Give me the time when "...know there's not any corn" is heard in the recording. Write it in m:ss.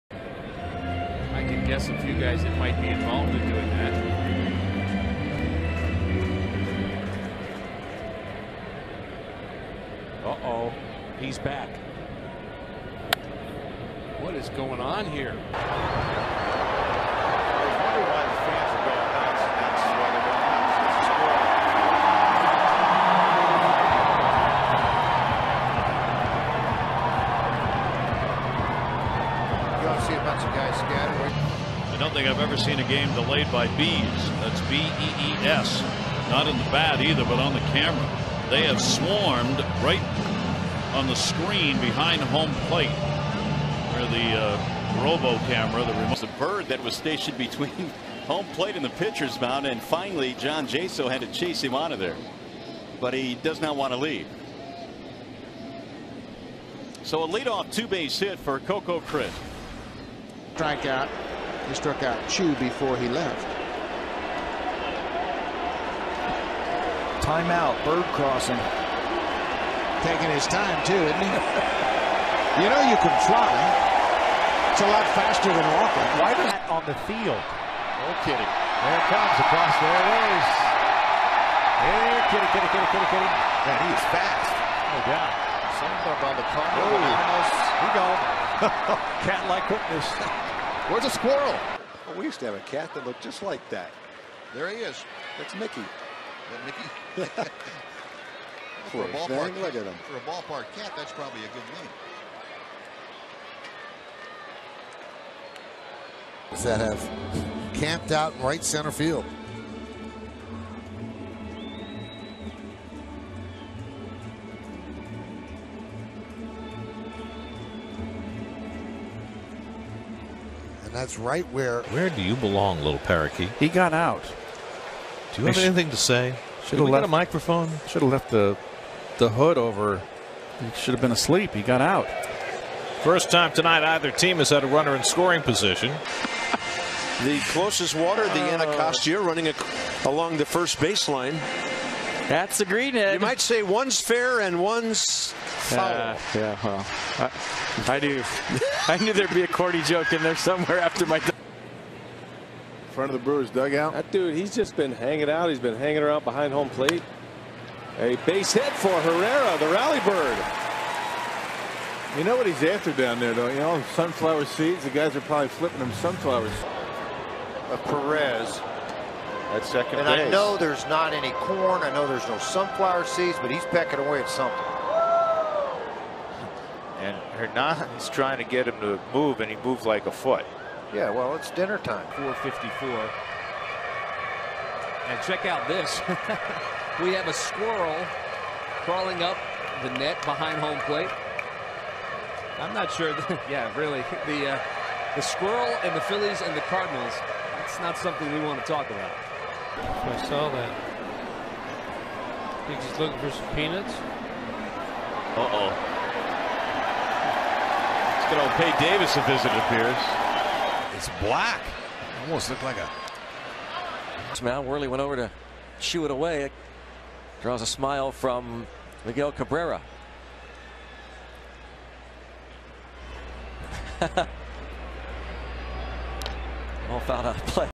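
2:50.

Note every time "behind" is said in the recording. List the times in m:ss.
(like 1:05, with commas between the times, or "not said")
0:41, 2:36, 3:10.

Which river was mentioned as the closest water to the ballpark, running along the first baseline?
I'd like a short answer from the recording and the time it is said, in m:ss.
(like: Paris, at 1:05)
Anacostia, at 2:18.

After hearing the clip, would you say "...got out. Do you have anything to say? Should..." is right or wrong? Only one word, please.
right.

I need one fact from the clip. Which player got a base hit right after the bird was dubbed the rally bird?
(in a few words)
Herrera.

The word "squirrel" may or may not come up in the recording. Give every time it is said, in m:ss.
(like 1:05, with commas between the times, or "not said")
1:31, 3:07, 3:15.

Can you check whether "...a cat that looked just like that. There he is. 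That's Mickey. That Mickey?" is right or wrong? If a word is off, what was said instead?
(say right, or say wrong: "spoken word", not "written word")
right.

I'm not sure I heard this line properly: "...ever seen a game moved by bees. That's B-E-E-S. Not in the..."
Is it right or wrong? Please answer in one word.
wrong.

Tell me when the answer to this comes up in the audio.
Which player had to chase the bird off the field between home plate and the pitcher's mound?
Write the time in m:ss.
0:50.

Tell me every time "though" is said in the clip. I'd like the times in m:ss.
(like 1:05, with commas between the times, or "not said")
2:43.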